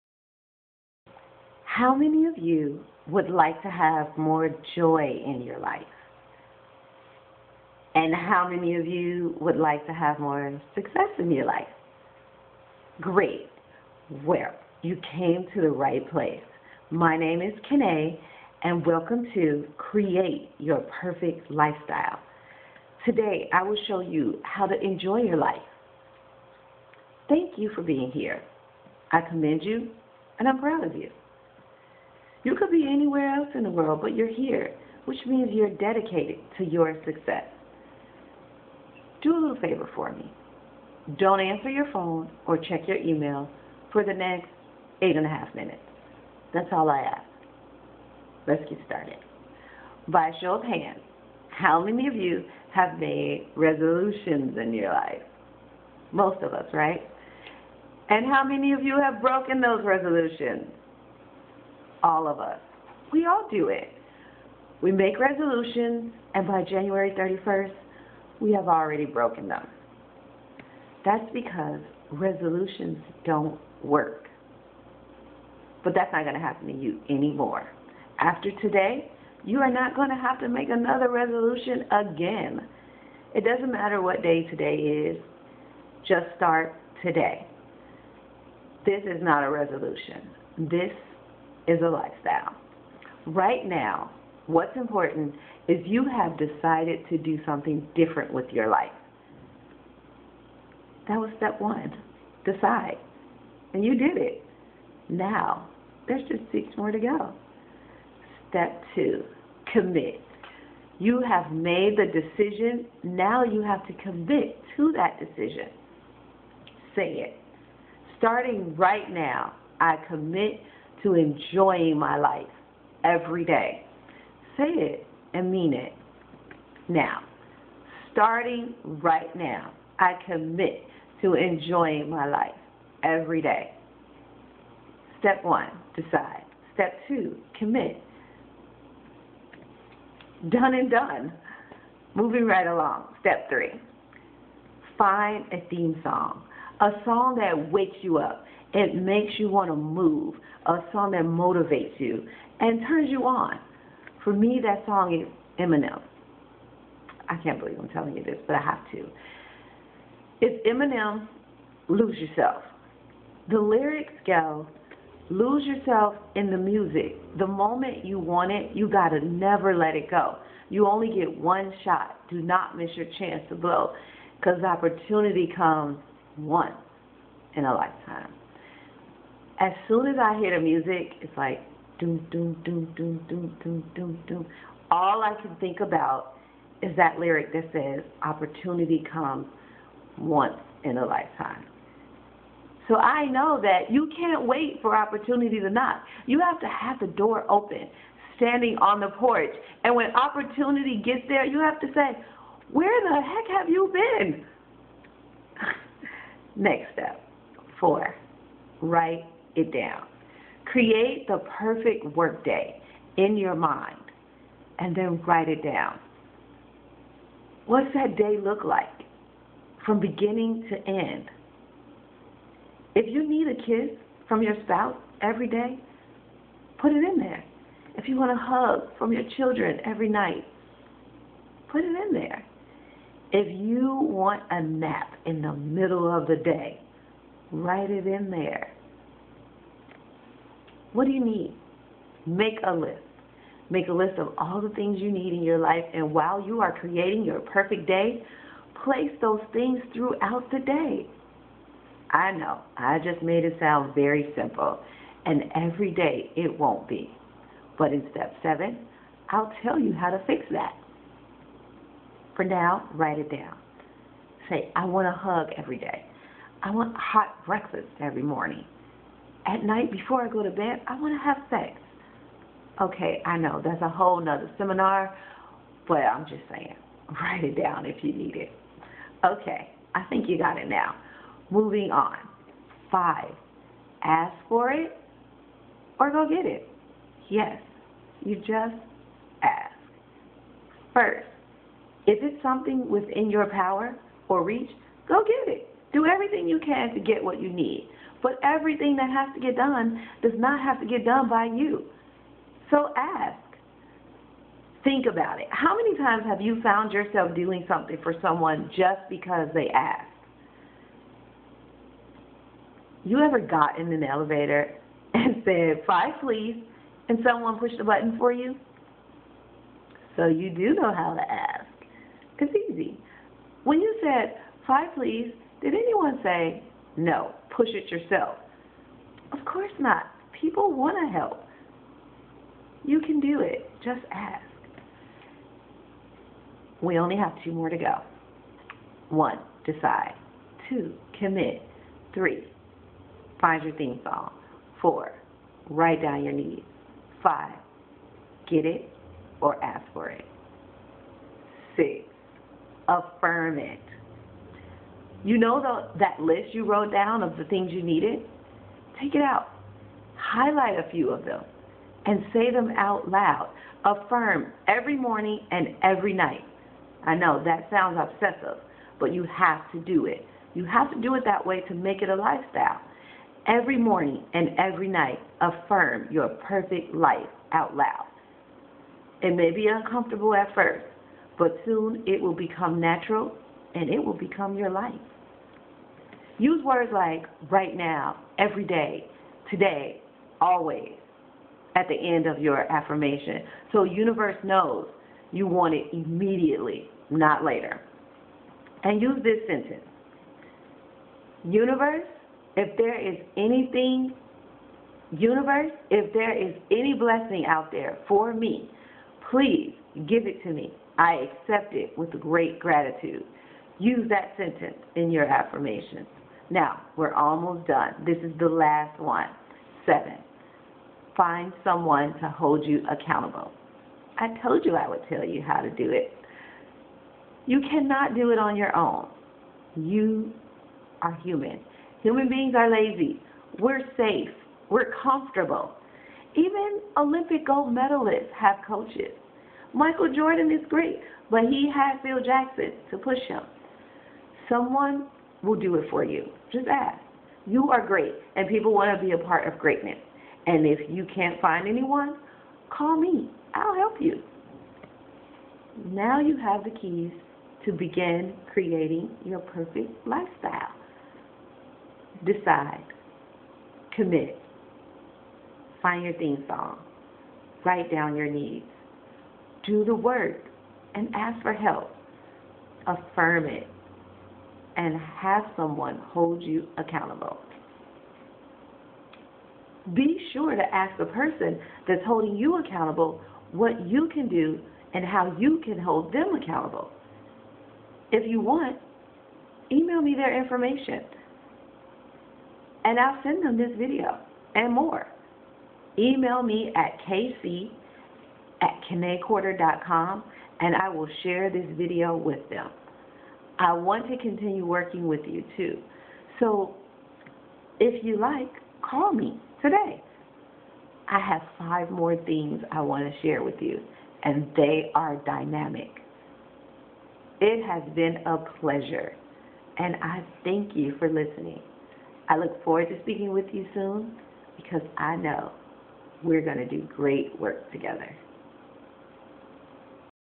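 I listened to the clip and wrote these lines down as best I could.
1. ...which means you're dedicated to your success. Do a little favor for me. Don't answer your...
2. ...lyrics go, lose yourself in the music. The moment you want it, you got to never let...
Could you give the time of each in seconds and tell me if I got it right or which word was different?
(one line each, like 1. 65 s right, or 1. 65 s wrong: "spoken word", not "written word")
1. 35 s right
2. 163 s right.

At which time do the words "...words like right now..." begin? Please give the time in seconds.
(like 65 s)
386 s.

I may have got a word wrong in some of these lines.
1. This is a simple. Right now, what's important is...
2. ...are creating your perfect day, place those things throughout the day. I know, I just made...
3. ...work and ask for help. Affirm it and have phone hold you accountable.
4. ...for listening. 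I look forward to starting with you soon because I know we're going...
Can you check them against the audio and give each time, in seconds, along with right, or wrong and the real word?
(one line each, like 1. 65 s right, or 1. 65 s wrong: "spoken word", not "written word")
1. 90 s wrong: "lifestyle", not "simple"
2. 246 s right
3. 469 s wrong: "someone", not "phone"
4. 520 s wrong: "speaking", not "starting".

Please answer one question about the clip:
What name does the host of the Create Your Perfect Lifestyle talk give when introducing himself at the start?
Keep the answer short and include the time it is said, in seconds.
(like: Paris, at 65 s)
Kine, at 17 s.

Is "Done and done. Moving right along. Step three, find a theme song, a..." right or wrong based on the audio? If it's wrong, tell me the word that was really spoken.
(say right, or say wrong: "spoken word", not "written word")
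right.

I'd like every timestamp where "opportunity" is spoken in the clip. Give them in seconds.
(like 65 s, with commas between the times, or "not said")
174 s, 188 s, 194 s, 200 s.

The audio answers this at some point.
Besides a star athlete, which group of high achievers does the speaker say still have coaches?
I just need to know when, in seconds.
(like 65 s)
436 s.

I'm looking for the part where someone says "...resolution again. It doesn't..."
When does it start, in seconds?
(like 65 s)
81 s.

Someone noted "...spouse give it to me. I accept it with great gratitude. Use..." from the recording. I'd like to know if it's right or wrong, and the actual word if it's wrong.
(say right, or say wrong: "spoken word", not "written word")
wrong: "please", not "spouse".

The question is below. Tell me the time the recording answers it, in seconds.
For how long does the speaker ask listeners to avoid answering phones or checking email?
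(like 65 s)
45 s.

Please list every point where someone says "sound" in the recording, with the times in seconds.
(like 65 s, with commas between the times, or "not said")
253 s, 367 s.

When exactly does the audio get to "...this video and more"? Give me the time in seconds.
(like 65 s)
493 s.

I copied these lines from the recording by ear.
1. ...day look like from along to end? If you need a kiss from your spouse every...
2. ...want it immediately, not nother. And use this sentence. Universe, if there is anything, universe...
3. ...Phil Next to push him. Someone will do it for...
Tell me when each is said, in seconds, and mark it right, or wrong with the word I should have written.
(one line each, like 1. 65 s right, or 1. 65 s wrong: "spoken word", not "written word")
1. 218 s wrong: "beginning", not "along"
2. 395 s wrong: "later", not "nother"
3. 442 s wrong: "Jackson", not "Next".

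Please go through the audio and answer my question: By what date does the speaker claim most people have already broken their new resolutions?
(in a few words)
January 31st.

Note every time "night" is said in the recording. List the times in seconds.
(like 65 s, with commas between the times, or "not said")
230 s, 269 s, 366 s, 374 s.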